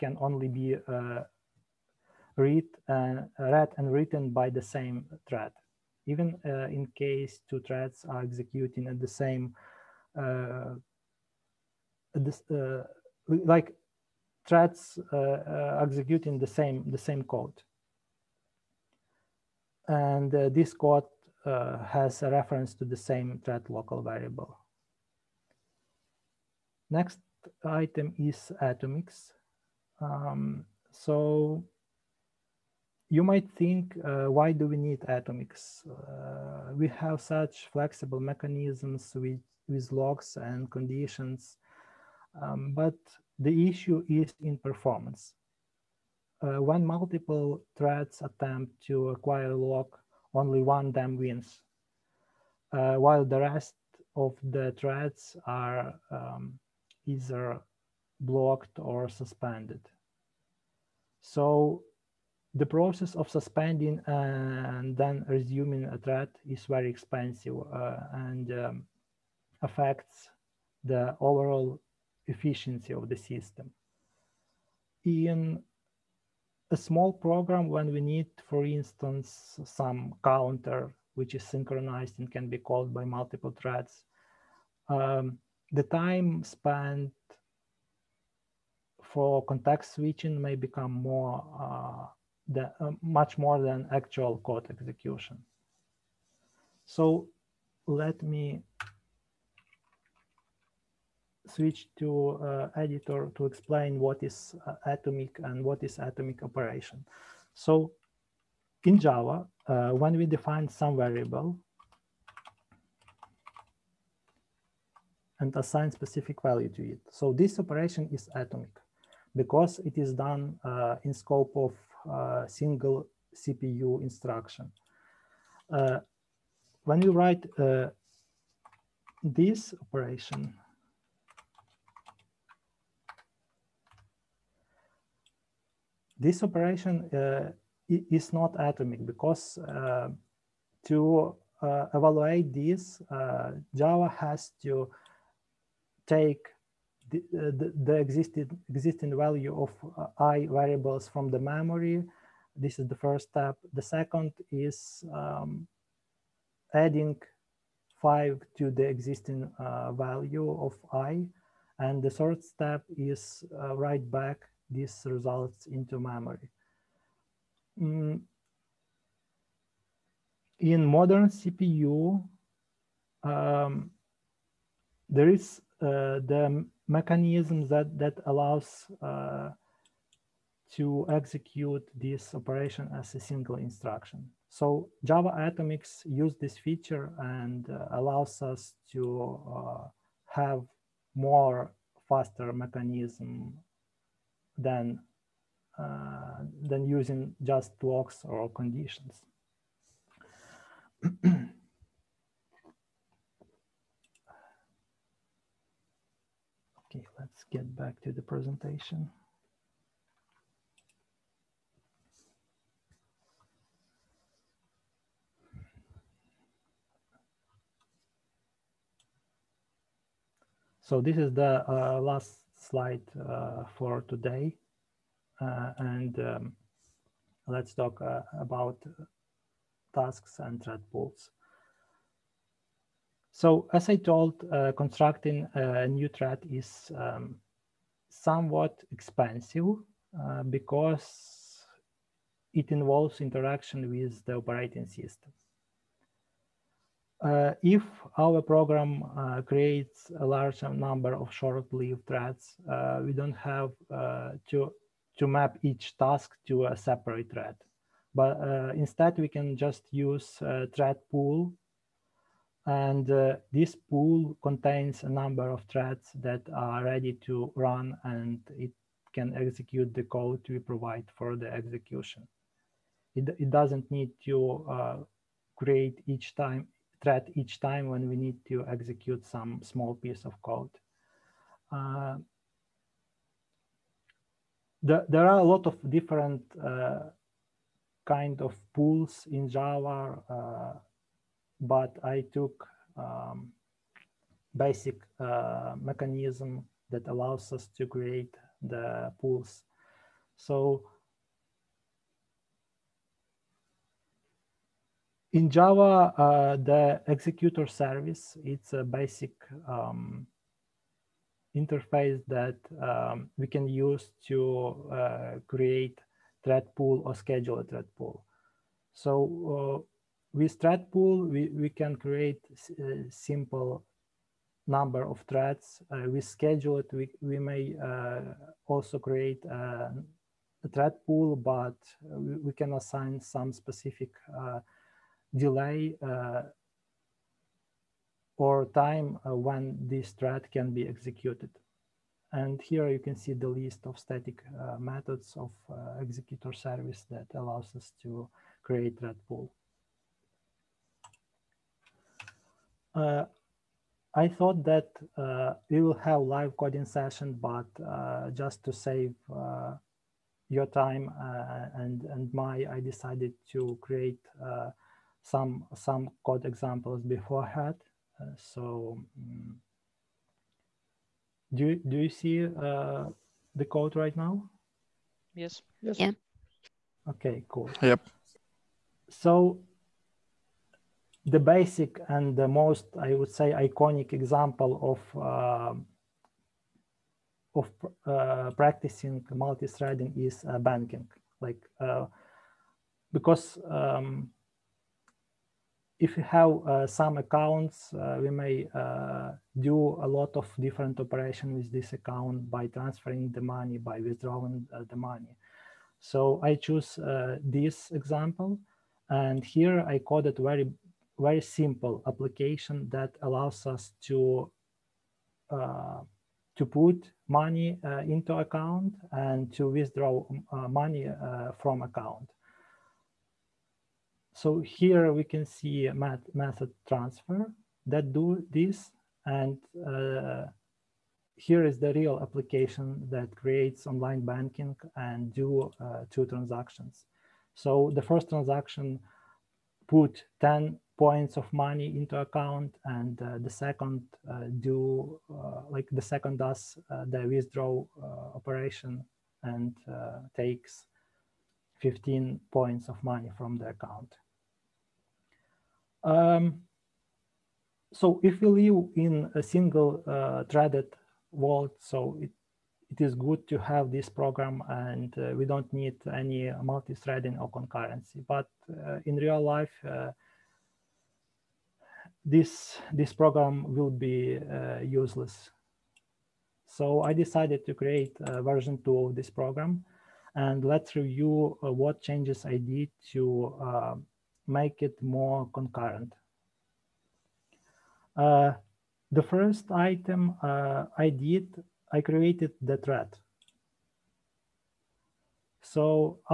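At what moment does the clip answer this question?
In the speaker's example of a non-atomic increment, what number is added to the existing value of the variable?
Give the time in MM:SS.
02:38.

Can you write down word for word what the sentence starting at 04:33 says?
It, it doesn't need to create each time thread each time when we need to execute some small piece of code.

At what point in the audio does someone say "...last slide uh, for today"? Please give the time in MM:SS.
03:42.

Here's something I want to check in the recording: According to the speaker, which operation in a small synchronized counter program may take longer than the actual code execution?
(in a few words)
context switching.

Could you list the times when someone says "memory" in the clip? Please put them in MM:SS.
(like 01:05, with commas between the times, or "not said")
02:31, 02:45.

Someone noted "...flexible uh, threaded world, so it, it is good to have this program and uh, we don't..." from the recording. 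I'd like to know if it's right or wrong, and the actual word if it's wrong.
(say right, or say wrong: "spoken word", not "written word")
wrong: "single", not "flexible".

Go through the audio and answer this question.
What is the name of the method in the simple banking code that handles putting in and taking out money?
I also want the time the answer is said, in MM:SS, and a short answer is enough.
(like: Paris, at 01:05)
transfer, at 07:06.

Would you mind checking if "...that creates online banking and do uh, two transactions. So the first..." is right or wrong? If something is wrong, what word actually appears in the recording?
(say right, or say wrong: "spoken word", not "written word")
right.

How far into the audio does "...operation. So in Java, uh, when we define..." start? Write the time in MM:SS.
01:46.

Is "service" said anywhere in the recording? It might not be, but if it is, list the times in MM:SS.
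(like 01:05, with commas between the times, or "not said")
05:07, 05:46.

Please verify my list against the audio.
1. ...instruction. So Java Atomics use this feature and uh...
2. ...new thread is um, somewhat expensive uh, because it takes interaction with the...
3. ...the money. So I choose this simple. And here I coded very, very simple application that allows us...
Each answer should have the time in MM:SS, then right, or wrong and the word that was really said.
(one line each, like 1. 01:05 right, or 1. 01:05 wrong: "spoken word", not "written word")
1. 03:03 right
2. 03:55 wrong: "involves", not "takes"
3. 06:44 wrong: "example", not "simple".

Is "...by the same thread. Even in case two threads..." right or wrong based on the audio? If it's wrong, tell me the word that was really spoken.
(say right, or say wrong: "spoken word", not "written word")
right.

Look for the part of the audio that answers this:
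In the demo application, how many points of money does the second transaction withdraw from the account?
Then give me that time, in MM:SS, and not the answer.
07:31.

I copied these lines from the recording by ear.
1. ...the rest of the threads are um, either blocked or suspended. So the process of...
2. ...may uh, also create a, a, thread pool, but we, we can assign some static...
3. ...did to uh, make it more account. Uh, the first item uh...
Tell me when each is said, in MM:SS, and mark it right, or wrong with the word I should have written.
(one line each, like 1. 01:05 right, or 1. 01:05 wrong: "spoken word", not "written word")
1. 00:53 right
2. 05:27 wrong: "specific", not "static"
3. 08:02 wrong: "concurrent", not "account".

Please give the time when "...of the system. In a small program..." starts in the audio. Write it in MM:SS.
01:12.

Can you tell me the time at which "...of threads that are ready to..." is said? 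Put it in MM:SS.
04:25.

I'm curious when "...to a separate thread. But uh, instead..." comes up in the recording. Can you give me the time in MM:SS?
04:16.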